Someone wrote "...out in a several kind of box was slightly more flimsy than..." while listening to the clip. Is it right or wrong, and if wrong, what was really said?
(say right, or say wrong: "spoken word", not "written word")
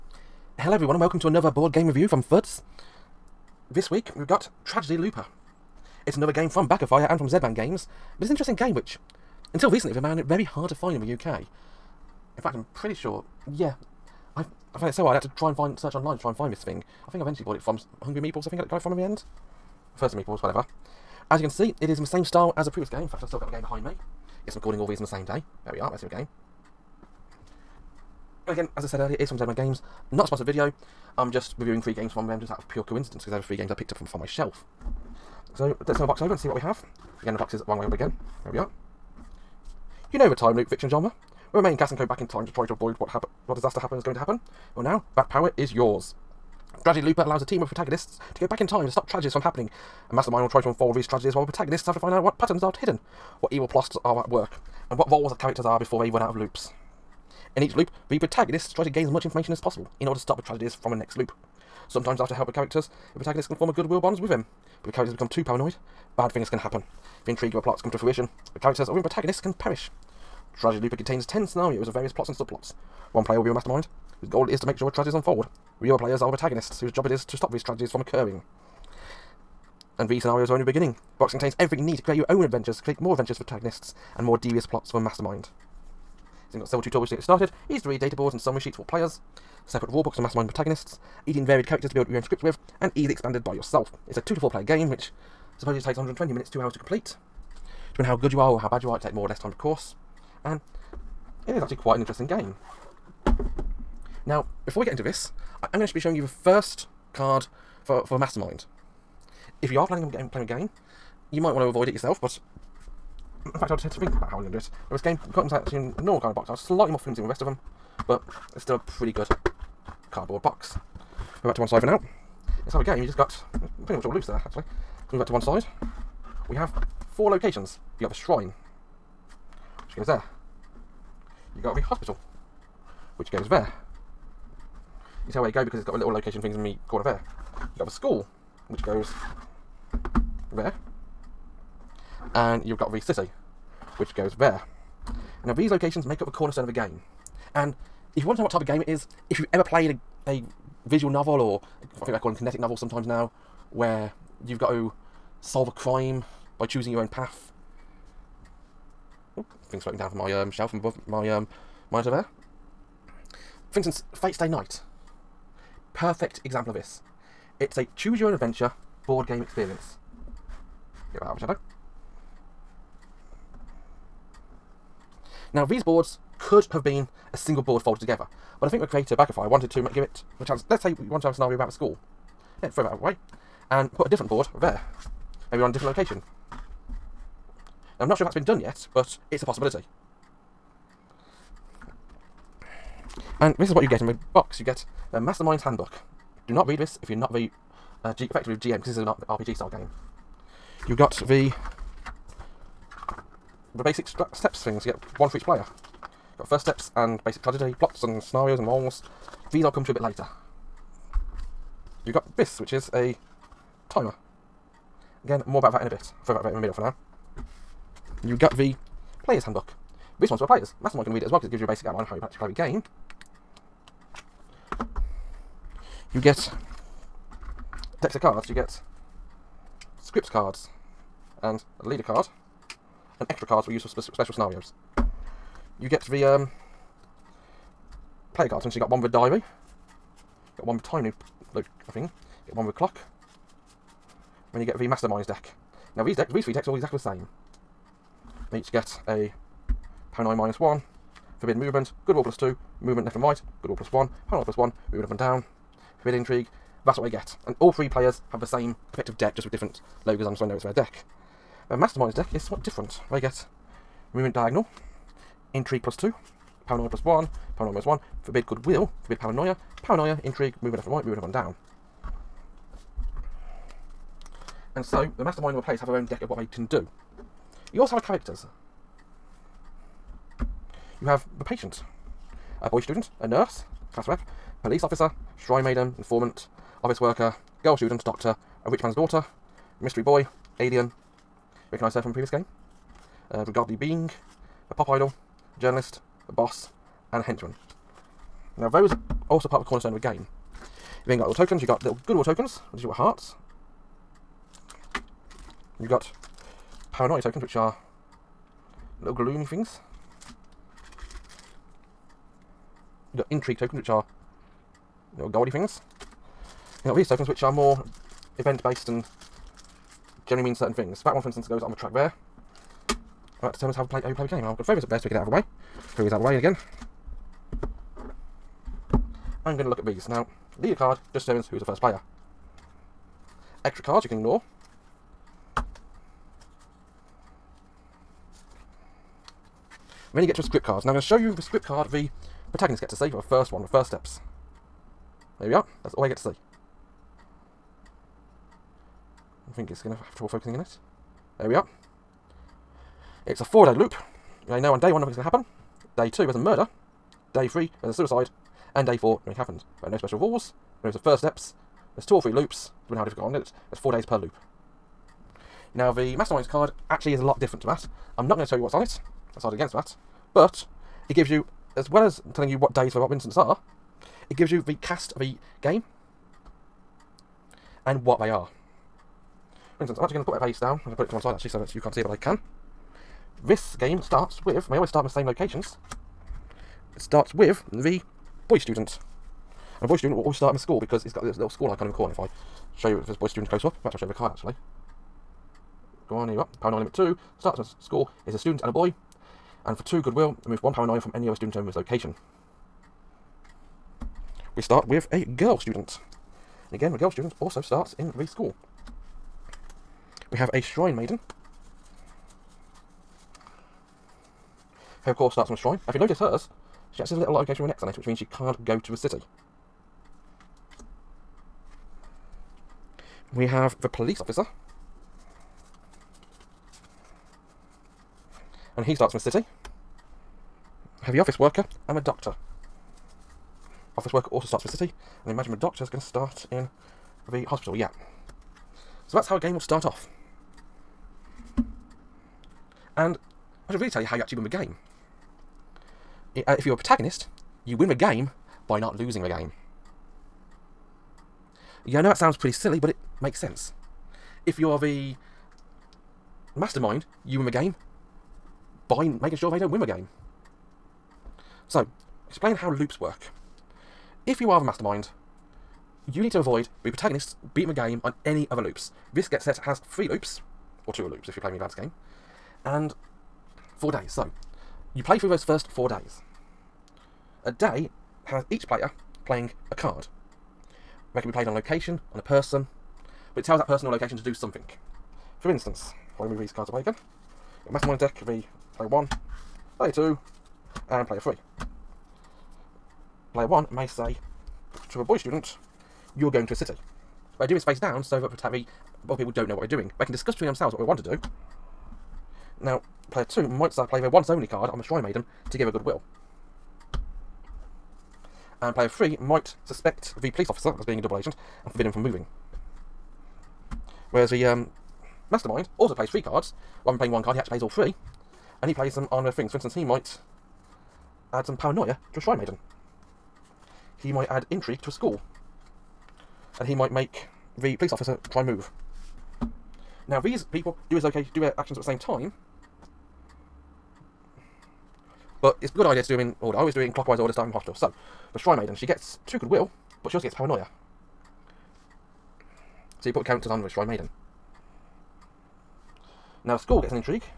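wrong: "normal", not "several".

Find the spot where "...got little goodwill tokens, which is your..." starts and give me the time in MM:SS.
05:01.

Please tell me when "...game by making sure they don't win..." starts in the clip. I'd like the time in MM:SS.
07:37.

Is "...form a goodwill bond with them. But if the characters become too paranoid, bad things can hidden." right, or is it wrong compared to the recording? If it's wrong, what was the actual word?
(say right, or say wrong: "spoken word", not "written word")
wrong: "happen", not "hidden".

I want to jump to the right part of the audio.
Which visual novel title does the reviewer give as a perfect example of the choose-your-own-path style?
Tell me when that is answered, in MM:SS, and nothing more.
02:44.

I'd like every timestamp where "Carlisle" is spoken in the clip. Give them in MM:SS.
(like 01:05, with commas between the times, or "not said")
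not said.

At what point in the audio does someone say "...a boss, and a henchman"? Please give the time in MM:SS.
04:56.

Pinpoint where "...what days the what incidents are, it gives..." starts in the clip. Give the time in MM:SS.
06:12.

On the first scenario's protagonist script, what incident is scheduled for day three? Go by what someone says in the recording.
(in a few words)
suicide.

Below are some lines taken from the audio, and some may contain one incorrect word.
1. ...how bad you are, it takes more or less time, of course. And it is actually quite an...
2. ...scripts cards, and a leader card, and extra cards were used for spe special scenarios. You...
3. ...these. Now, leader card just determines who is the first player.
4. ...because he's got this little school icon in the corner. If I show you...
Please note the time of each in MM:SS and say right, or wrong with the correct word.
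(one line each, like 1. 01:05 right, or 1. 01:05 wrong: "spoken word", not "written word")
1. 01:38 right
2. 03:50 right
3. 05:29 right
4. 06:30 right.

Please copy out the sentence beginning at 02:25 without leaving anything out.
Now these locations make up the cornerstone of the game.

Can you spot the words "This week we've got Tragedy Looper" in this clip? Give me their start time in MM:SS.
00:03.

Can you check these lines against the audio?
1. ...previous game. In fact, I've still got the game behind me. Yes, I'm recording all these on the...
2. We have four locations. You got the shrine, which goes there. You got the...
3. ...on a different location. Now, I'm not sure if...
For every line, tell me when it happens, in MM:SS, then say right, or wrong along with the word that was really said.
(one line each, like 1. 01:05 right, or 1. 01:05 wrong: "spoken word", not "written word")
1. 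00:22 right
2. 02:06 right
3. 03:05 right.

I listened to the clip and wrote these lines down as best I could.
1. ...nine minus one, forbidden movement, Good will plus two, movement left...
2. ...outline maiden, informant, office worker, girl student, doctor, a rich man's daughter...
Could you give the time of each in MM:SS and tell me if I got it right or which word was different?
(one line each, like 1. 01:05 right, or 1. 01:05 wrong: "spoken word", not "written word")
1. 04:10 right
2. 04:45 wrong: "shrine", not "outline".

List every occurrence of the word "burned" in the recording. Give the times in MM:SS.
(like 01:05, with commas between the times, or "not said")
not said.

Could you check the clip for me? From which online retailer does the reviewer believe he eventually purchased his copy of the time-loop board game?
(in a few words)
Hungry Meatballs.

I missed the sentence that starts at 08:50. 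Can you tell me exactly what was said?
Now these people do his location do their actions at the same time.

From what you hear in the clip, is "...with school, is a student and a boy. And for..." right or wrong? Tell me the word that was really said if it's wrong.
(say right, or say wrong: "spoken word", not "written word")
right.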